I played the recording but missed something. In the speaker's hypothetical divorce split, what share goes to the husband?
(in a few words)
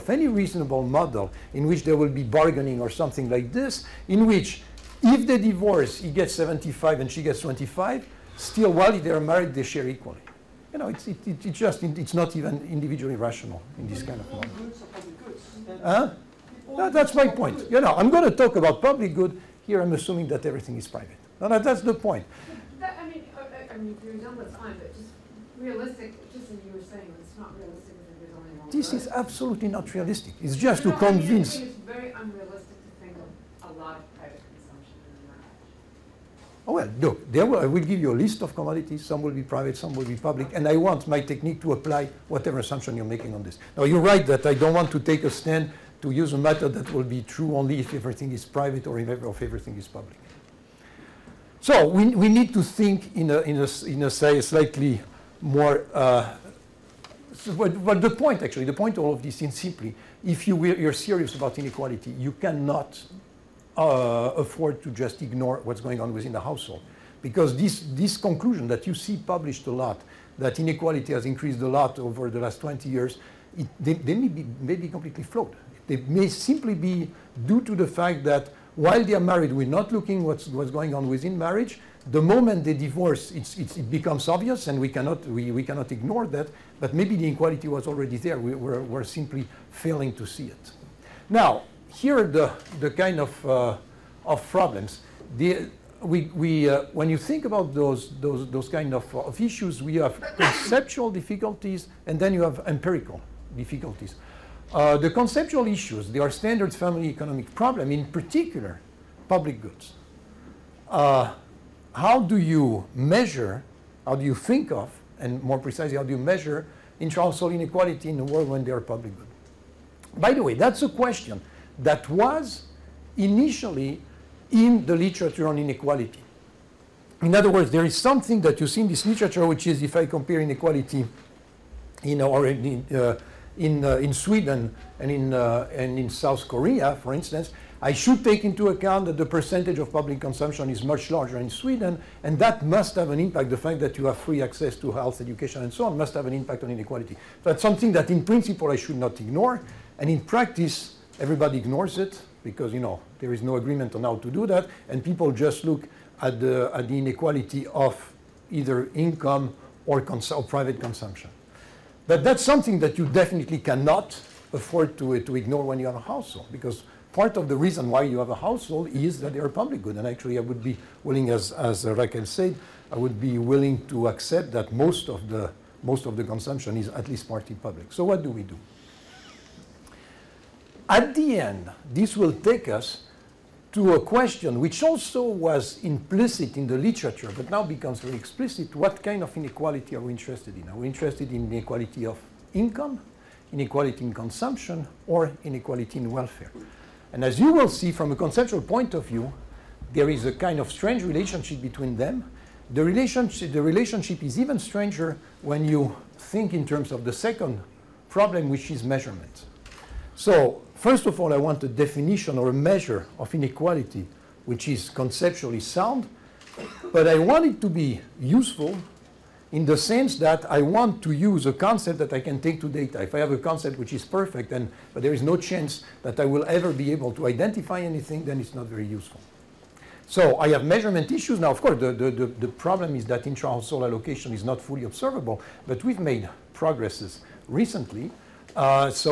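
75.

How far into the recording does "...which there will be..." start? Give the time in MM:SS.
00:01.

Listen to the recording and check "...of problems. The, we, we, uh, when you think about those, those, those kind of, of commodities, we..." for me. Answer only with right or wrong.
wrong.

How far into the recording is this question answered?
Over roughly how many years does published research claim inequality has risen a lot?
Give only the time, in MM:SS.
01:12.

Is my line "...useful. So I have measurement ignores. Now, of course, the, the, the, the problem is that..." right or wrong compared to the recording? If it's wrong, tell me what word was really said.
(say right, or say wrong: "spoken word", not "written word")
wrong: "issues", not "ignores".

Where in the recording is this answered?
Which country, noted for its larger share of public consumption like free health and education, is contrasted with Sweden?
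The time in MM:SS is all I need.
02:16.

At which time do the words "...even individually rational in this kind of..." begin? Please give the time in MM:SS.
00:12.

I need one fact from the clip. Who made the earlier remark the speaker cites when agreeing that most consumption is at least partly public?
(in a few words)
Raquel.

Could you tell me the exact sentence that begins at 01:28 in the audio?
We, we're, we're simply failing to see it.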